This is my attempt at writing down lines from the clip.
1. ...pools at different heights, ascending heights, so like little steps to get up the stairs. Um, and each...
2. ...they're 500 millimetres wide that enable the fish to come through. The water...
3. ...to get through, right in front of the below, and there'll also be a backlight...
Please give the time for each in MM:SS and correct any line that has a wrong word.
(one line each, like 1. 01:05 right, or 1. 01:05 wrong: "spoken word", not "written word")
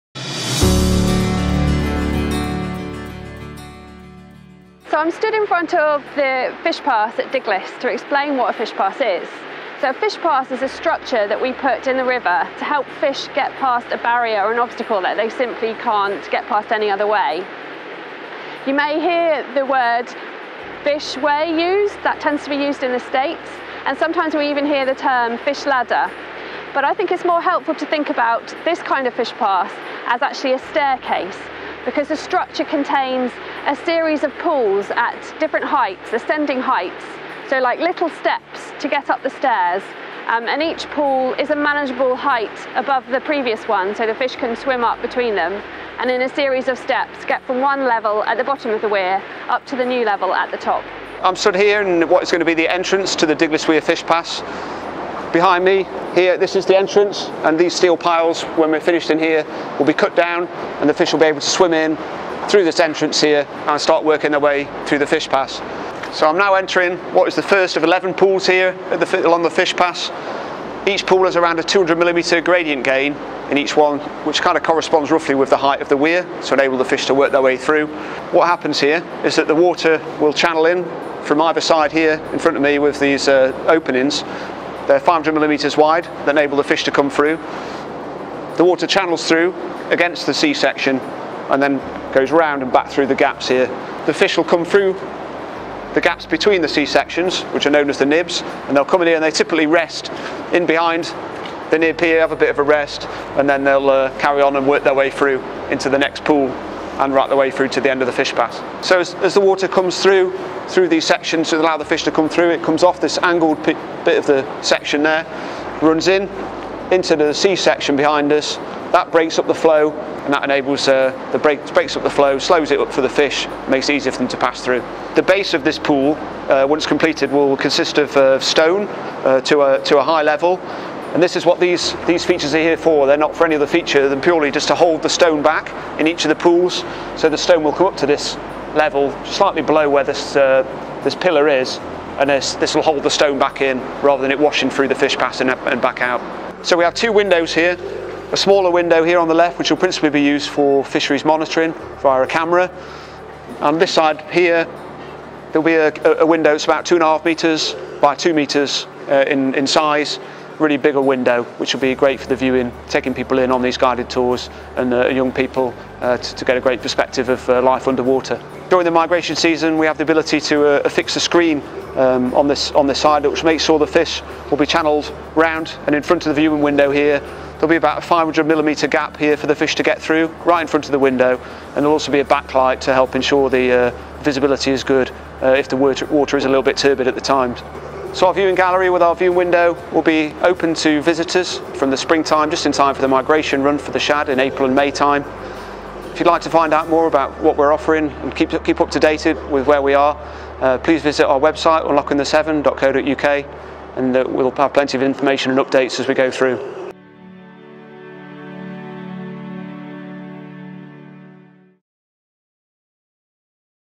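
1. 00:34 right
2. 01:24 right
3. 02:59 wrong: "window", not "below".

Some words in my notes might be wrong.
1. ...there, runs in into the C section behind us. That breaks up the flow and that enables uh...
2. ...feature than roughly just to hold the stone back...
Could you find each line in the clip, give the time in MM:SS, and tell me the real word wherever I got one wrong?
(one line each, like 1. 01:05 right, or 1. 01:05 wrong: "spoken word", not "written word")
1. 01:55 right
2. 02:13 wrong: "purely", not "roughly".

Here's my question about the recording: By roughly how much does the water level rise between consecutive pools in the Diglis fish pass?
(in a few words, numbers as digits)
200 millimetres.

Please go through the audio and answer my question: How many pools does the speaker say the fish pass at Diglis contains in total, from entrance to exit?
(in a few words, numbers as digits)
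11.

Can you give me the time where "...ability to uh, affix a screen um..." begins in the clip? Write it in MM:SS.
02:50.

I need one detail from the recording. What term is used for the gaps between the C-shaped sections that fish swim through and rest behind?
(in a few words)
nibs.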